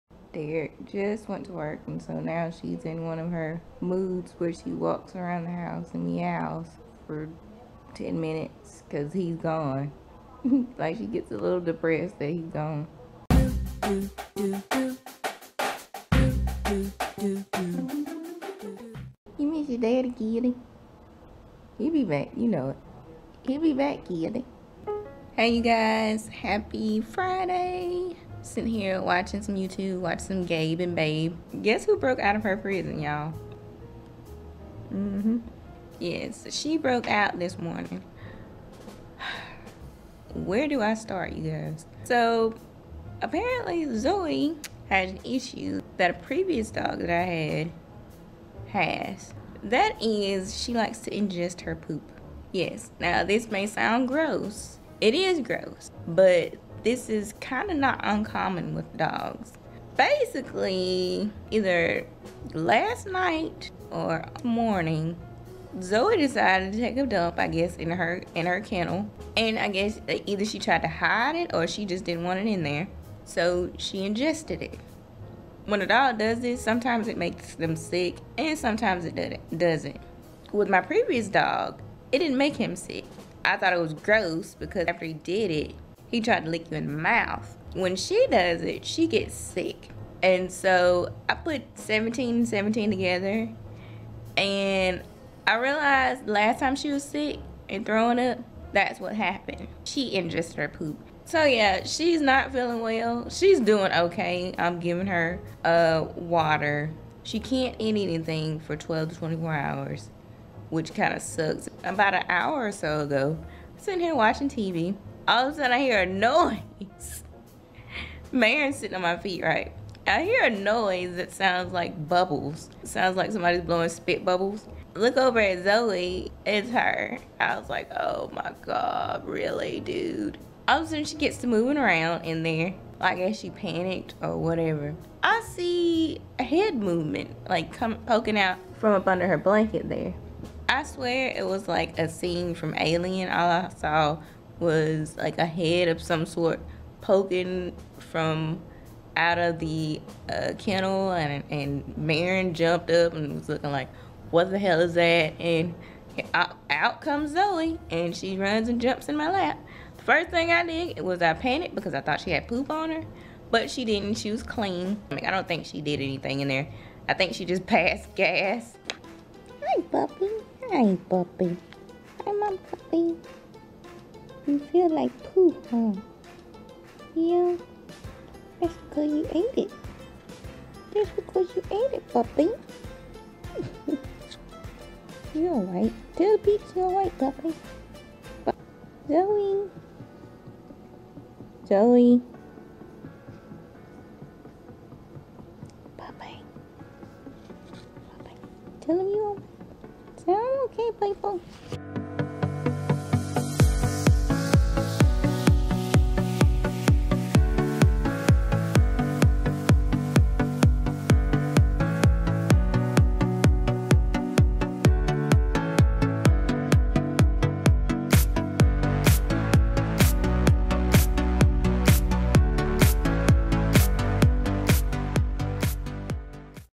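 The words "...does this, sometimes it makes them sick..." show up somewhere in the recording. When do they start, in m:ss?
1:16.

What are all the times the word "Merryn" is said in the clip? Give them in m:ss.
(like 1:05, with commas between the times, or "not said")
1:58, 2:31.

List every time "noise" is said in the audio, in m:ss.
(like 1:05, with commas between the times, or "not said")
1:56, 2:00.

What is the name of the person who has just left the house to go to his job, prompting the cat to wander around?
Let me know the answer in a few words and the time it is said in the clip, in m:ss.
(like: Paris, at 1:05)
Derrick, at 0:00.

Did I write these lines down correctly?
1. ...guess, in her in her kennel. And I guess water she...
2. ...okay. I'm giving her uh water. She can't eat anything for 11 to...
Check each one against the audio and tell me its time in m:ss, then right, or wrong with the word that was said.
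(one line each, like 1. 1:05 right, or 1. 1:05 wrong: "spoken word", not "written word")
1. 1:07 wrong: "either", not "water"
2. 1:43 wrong: "12", not "11".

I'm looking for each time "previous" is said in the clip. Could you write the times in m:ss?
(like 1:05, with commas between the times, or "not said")
0:46, 1:20.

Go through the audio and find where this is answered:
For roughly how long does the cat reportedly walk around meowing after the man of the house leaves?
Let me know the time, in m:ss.
0:07.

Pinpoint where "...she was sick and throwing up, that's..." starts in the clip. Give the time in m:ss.
1:36.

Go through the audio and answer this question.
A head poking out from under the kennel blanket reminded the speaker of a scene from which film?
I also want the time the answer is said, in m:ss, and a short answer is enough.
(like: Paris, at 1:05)
Alien, at 2:22.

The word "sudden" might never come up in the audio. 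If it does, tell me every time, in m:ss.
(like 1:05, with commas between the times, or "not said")
1:55, 2:10.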